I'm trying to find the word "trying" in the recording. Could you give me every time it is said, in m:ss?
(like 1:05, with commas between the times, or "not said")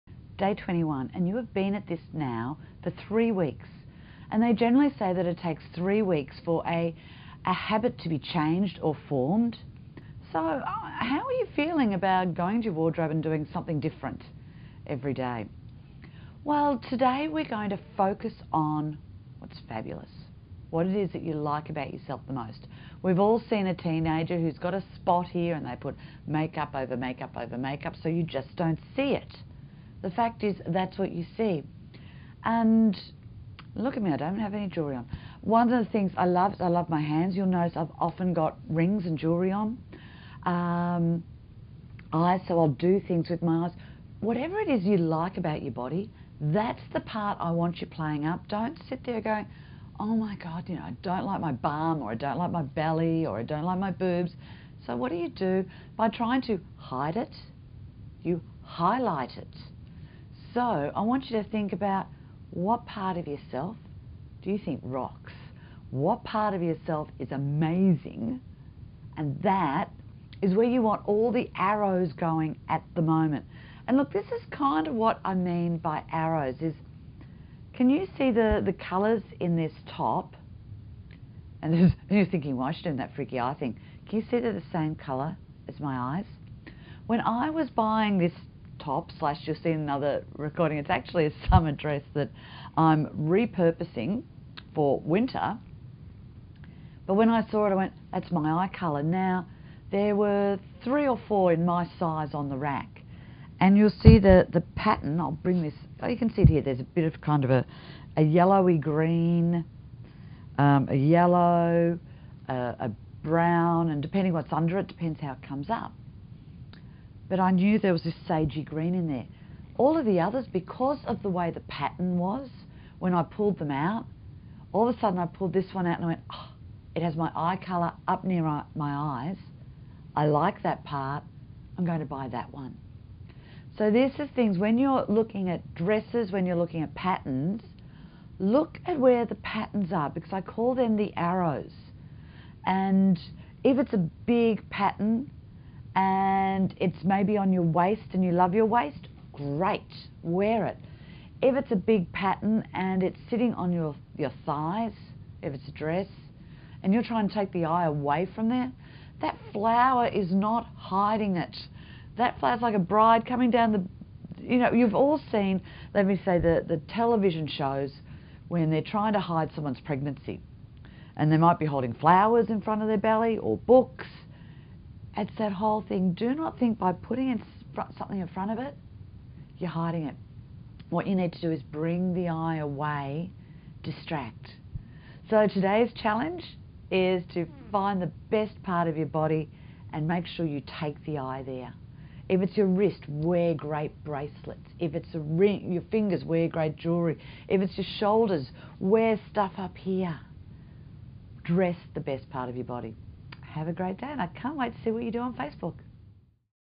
0:56, 2:37, 2:48.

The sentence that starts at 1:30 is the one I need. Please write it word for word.
It's actually a summer dress that I'm repurposing for winter.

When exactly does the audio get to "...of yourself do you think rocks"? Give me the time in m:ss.
1:03.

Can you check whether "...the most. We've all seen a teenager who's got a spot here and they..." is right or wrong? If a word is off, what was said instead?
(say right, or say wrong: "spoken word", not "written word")
right.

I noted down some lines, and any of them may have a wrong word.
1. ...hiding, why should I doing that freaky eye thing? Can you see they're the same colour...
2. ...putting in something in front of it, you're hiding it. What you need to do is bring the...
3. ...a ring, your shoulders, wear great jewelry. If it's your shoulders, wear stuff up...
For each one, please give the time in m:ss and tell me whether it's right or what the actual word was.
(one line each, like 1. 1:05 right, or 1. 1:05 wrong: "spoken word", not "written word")
1. 1:22 wrong: "thinking", not "hiding"
2. 2:56 right
3. 3:15 wrong: "fingers", not "shoulders".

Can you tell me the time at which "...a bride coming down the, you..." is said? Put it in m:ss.
2:42.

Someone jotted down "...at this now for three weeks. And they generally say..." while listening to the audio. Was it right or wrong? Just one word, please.
right.